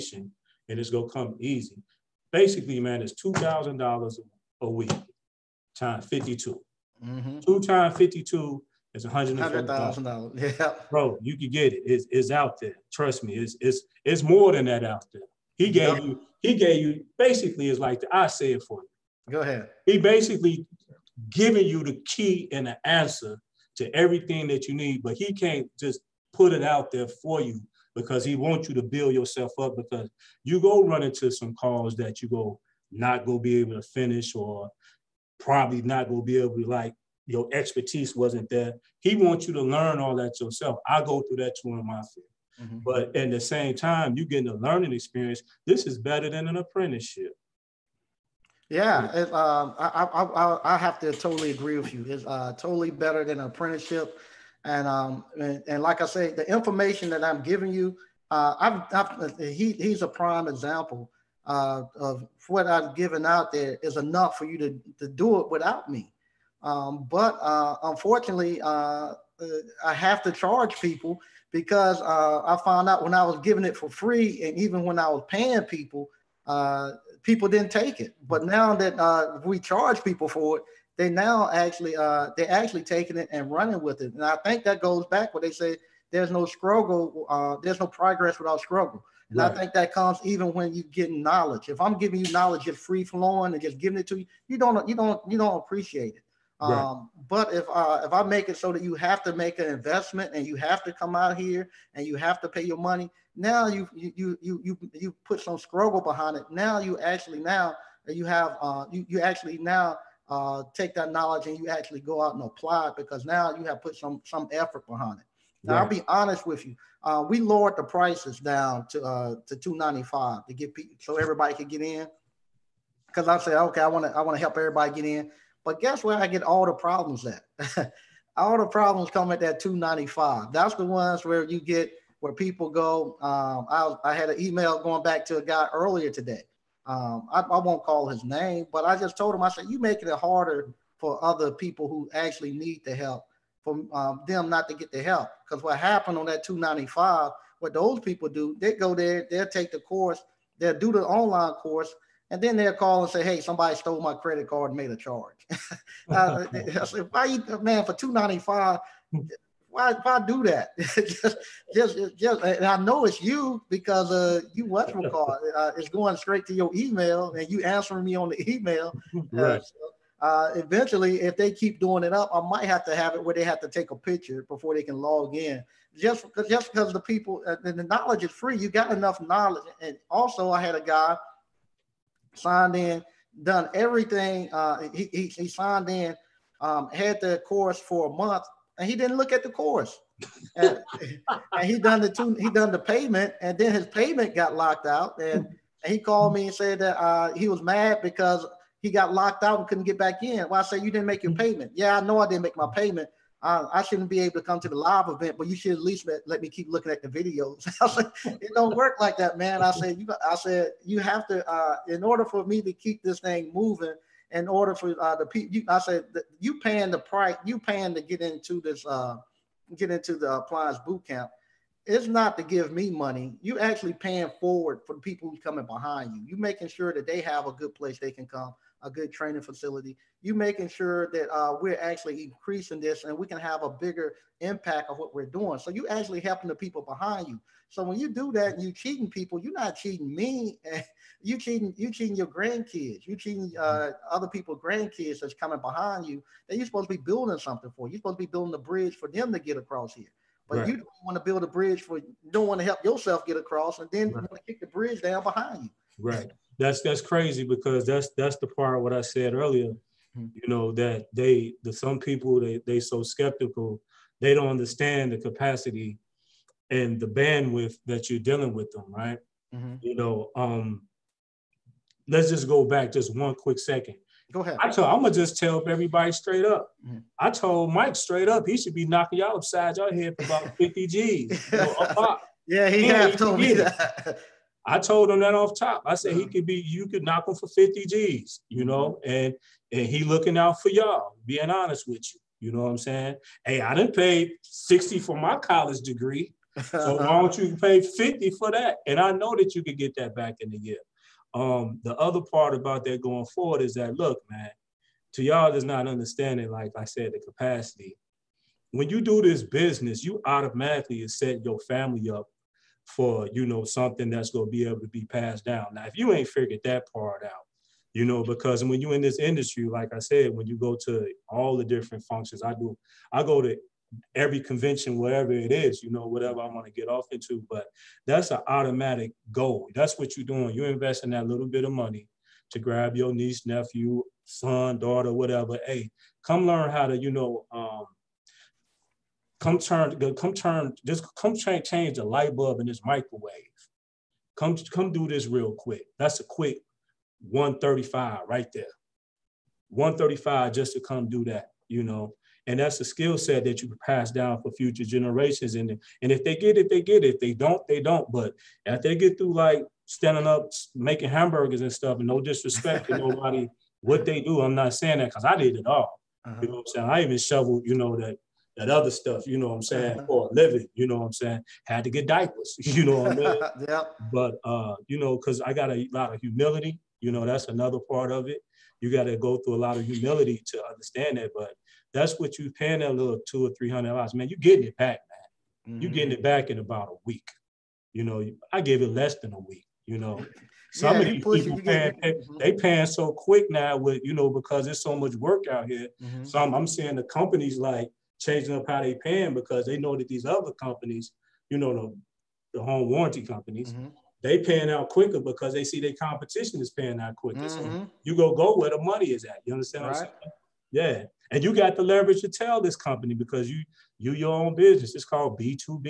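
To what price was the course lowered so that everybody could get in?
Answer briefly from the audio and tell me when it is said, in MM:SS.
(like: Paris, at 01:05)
$295, at 01:59.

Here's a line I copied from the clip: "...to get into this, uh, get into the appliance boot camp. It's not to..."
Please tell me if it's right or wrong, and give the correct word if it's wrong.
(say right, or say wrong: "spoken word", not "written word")
right.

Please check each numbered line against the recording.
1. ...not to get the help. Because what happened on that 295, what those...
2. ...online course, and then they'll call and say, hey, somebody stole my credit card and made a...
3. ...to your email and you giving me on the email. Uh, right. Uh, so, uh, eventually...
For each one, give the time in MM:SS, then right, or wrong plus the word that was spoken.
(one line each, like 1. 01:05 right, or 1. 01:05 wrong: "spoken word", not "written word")
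1. 02:24 right
2. 02:31 right
3. 02:46 wrong: "answering", not "giving".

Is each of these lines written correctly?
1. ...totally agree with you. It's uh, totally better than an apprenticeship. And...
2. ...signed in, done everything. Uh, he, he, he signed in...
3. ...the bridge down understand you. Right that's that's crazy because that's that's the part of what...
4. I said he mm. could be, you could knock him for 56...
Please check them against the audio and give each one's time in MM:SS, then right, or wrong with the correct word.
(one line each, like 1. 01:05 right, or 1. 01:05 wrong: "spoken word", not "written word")
1. 00:51 right
2. 03:02 right
3. 04:14 wrong: "behind", not "understand"
4. 04:45 wrong: "50", not "56".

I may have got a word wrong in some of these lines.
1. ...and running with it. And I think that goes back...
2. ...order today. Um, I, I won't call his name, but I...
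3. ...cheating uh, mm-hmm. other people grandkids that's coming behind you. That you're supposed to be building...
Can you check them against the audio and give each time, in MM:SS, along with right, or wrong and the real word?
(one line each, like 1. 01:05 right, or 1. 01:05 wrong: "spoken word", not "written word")
1. 01:23 right
2. 02:15 wrong: "earlier", not "order"
3. 04:03 right.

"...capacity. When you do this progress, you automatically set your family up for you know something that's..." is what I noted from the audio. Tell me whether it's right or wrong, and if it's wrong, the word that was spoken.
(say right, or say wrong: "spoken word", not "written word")
wrong: "business", not "progress".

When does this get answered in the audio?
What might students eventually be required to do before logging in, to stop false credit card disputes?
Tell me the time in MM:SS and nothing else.
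02:53.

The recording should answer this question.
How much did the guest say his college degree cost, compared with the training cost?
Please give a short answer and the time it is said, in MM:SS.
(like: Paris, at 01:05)
60, at 04:54.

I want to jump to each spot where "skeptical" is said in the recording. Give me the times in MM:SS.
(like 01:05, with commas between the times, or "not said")
04:23.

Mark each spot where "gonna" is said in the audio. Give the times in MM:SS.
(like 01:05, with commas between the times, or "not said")
00:00, 04:35.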